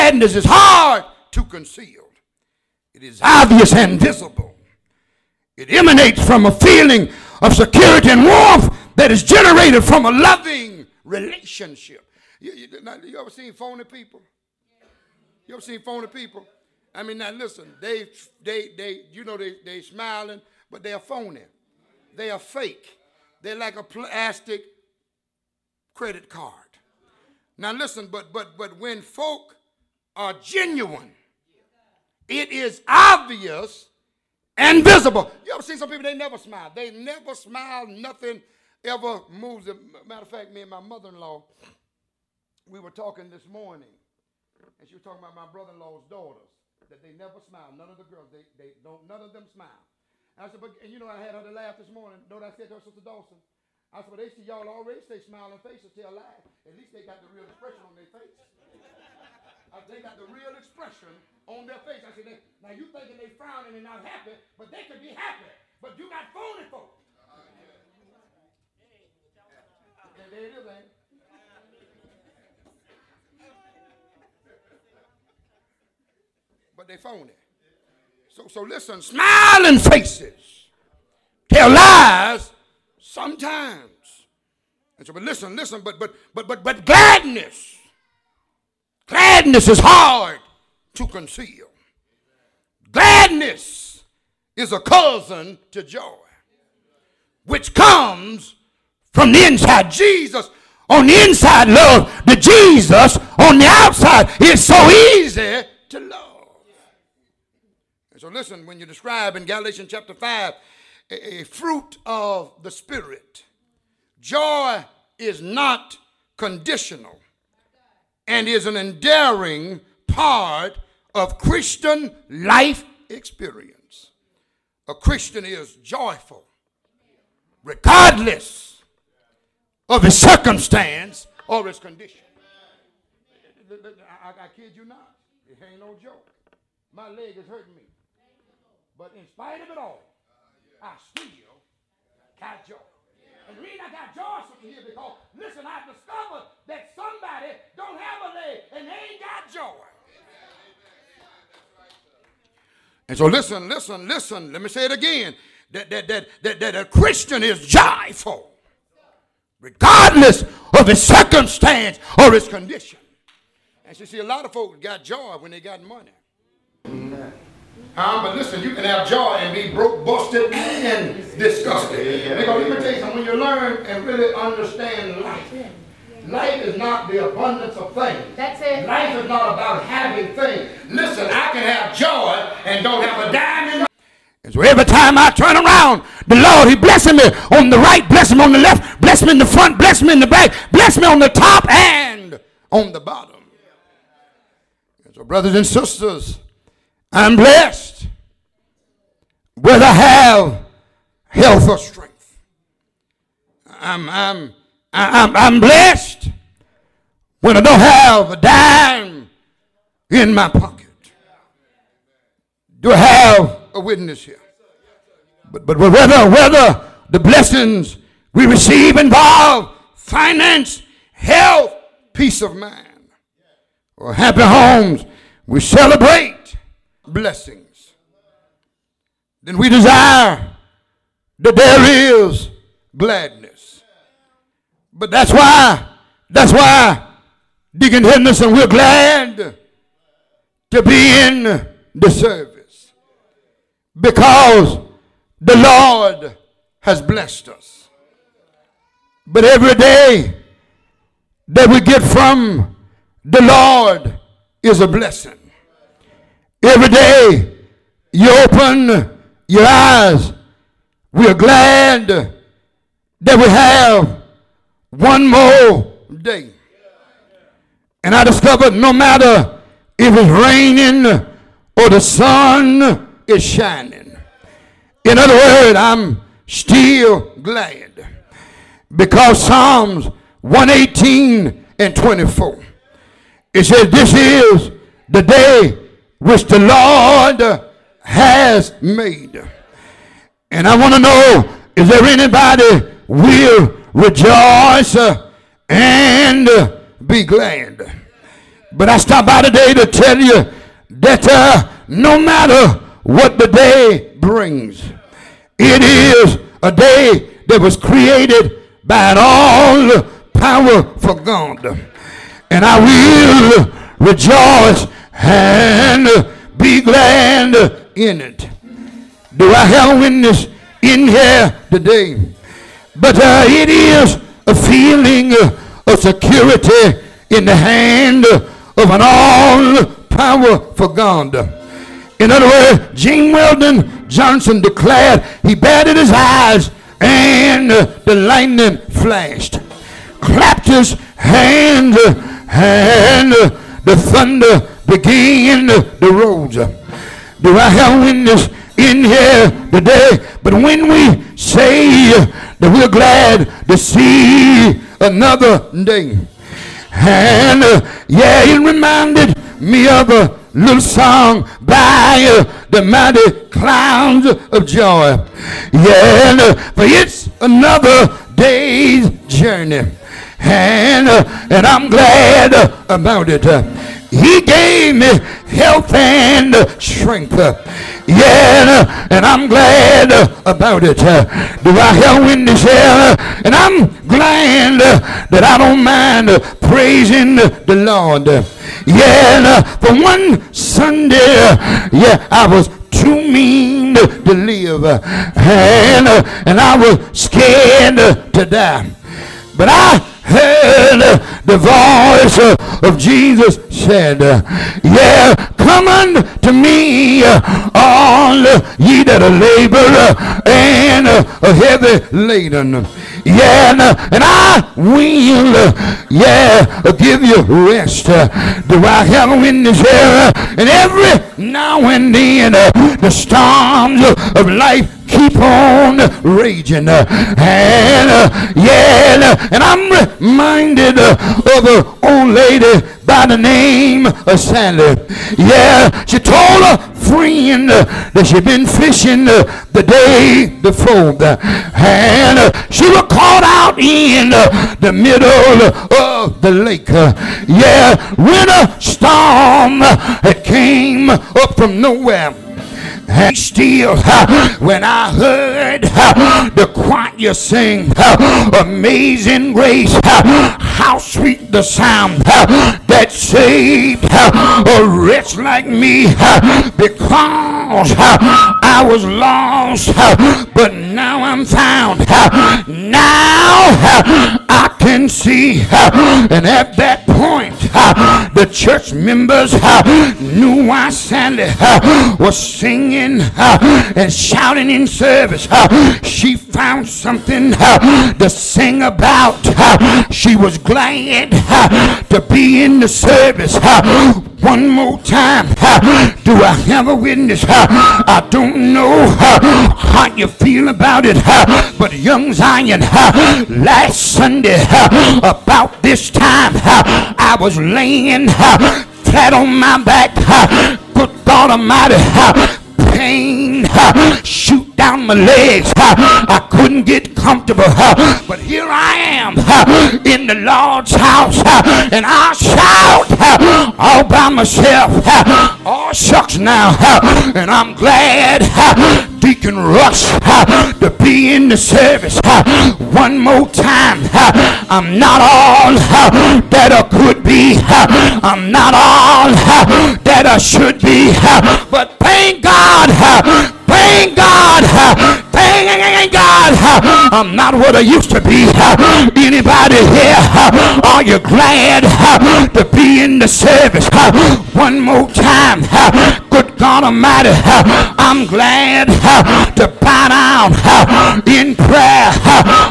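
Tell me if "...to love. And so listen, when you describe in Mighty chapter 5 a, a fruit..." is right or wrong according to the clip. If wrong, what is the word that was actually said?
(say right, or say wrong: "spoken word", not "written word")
wrong: "Galatians", not "Mighty".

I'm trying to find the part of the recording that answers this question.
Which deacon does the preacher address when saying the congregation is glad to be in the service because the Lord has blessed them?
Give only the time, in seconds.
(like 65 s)
237 s.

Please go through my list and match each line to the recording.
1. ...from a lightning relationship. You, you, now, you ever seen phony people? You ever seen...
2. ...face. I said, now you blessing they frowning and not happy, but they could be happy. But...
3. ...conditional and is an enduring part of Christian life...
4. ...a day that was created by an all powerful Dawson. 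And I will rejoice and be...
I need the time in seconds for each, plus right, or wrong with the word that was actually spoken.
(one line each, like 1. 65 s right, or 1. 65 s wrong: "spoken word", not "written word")
1. 9 s wrong: "loving", not "lightning"
2. 61 s wrong: "thinking", not "blessing"
3. 116 s right
4. 306 s wrong: "God", not "Dawson".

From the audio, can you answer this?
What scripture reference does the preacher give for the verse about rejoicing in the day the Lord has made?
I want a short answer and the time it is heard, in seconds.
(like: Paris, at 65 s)
Psalms 118:24, at 279 s.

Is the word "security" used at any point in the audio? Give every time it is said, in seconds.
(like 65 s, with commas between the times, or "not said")
7 s, 325 s.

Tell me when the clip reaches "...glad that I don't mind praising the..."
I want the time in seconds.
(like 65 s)
384 s.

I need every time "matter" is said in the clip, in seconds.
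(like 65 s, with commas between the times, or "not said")
40 s, 268 s, 302 s.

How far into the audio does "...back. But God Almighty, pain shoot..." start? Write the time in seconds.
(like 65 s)
509 s.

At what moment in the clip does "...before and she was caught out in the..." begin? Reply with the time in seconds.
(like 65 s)
440 s.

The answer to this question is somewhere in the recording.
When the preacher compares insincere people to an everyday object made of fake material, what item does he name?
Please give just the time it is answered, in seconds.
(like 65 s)
23 s.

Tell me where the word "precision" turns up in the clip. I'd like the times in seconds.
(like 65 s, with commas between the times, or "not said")
not said.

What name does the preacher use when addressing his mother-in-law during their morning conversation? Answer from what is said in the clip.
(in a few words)
Sister Dawson.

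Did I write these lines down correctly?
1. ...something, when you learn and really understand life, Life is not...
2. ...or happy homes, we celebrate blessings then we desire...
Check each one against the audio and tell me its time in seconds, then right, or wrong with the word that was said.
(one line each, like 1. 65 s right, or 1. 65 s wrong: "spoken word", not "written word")
1. 172 s right
2. 223 s right.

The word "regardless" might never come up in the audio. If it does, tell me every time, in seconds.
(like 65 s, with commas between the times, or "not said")
127 s, 159 s.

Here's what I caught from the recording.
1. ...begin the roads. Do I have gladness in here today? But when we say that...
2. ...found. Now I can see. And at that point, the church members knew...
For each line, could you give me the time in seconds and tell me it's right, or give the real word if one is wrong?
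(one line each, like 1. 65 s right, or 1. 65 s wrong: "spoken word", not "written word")
1. 344 s wrong: "witness", not "gladness"
2. 471 s right.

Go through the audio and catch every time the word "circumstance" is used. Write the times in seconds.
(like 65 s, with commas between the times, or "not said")
130 s, 160 s.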